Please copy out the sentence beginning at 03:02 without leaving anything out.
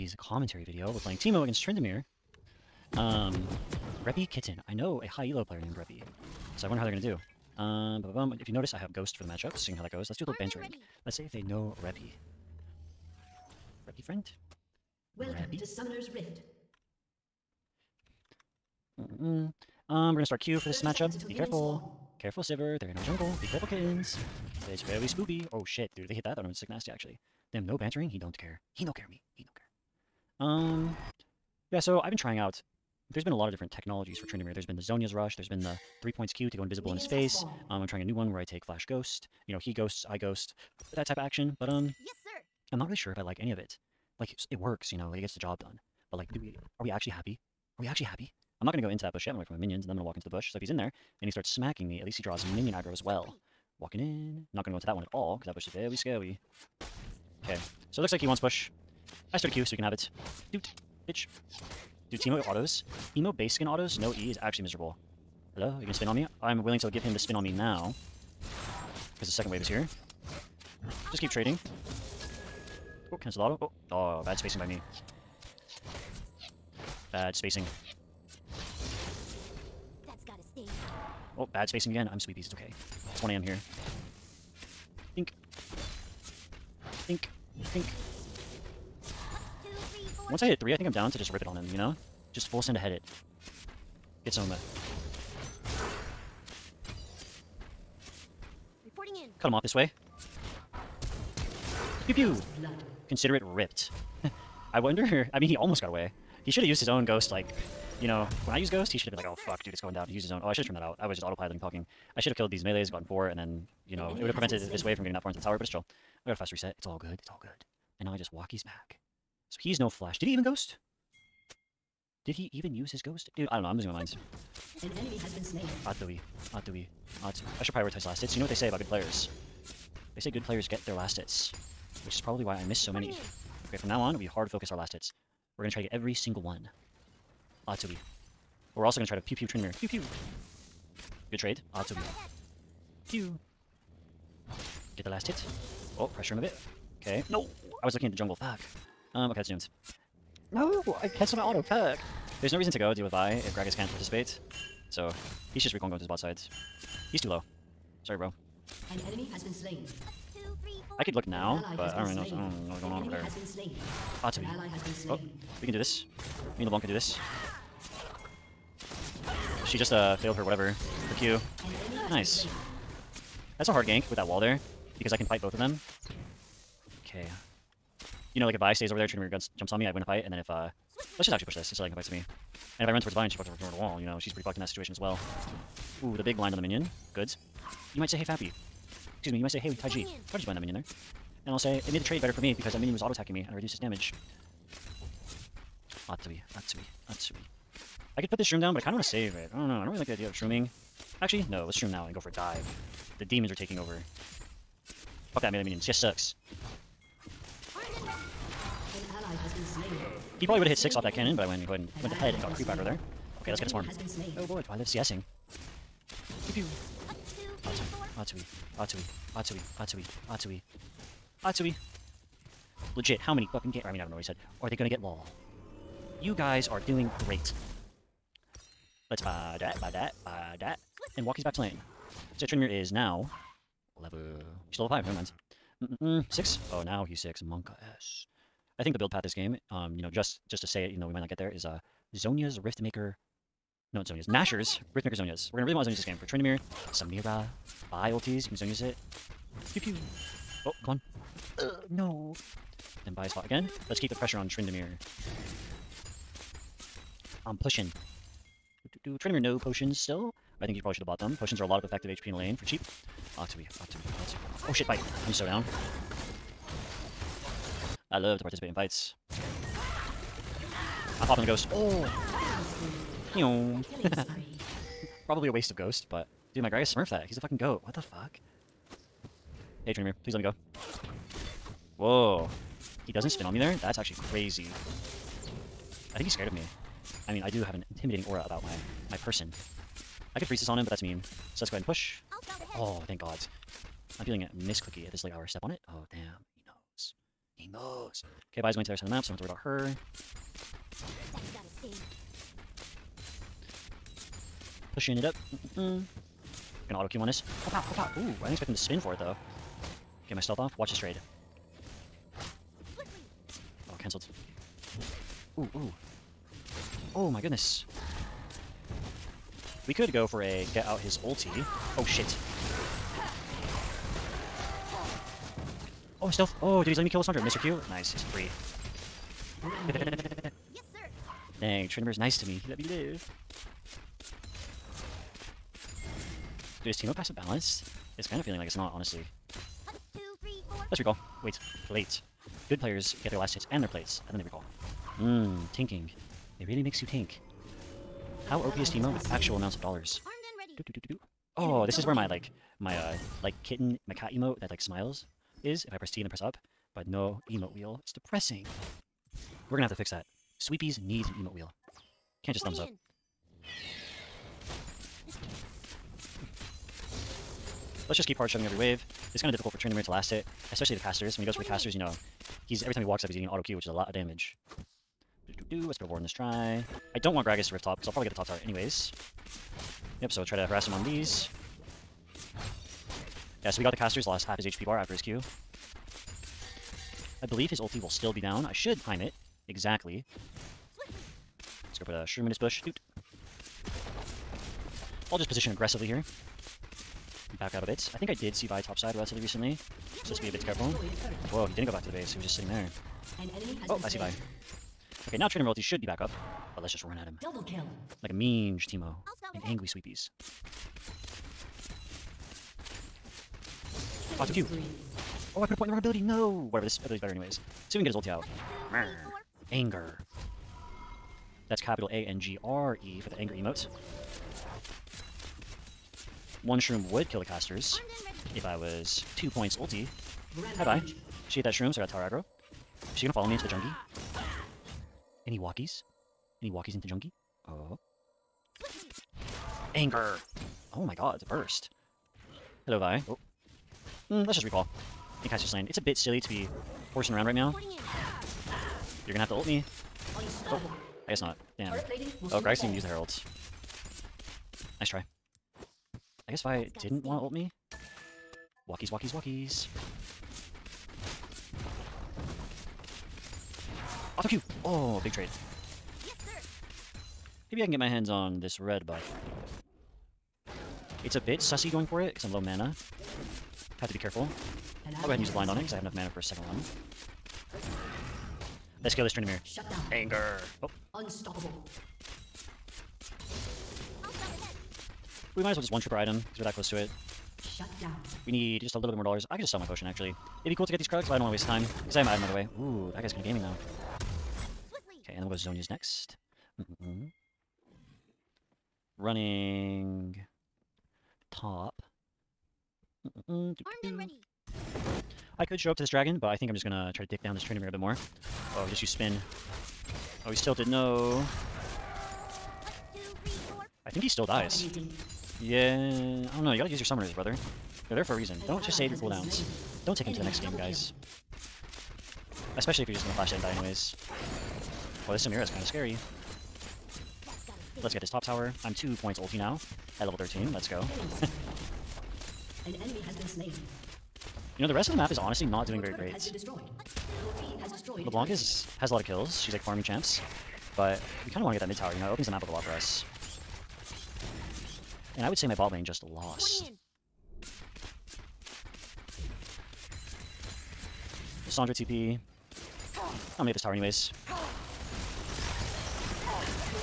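And if I run towards Vine, she fucks over the wall, you know.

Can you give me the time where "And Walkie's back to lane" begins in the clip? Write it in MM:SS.
03:51.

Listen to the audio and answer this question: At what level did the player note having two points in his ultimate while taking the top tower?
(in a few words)
13.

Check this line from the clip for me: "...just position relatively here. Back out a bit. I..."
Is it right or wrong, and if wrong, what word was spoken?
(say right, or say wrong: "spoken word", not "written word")
wrong: "aggressively", not "relatively".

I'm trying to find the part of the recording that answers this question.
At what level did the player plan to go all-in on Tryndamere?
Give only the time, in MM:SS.
01:30.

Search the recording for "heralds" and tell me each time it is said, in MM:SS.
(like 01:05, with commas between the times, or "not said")
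07:33.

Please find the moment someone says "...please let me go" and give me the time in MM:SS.
04:40.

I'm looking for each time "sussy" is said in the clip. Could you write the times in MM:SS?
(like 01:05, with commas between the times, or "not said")
07:51.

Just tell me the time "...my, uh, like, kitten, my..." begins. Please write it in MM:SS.
05:52.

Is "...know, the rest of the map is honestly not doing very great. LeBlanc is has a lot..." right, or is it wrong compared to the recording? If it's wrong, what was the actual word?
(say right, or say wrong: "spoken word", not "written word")
right.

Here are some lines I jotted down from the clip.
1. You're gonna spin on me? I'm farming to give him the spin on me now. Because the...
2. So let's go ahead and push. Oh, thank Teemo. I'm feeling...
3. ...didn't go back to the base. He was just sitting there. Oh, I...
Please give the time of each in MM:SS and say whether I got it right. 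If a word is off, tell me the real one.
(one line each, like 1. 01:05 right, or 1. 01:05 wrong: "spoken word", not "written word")
1. 01:05 wrong: "willing", not "farming"
2. 04:51 wrong: "God", not "Teemo"
3. 06:41 right.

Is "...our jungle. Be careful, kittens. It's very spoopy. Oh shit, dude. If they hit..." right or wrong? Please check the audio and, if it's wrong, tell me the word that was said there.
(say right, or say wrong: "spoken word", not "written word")
right.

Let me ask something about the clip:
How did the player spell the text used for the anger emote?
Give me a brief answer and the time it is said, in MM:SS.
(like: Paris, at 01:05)
A-N-G-R-E, at 07:01.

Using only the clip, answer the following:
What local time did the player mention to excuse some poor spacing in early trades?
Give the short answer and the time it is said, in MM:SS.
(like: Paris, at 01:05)
1 a.m., at 01:23.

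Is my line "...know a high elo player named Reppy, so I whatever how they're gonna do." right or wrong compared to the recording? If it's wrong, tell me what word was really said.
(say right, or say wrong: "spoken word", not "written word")
wrong: "wonder", not "whatever".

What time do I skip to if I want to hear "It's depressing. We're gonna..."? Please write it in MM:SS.
05:58.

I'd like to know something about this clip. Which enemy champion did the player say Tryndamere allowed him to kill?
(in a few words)
Lissandra.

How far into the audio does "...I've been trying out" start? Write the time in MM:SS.
00:31.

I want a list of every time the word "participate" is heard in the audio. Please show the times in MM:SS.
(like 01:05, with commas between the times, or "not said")
02:33, 04:28.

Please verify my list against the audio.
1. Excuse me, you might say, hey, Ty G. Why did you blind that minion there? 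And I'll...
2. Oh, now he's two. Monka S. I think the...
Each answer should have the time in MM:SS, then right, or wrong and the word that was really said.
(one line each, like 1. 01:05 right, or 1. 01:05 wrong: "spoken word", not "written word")
1. 03:09 right
2. 03:56 wrong: "six", not "two".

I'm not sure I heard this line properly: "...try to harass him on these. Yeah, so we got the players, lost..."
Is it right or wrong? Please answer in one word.
wrong.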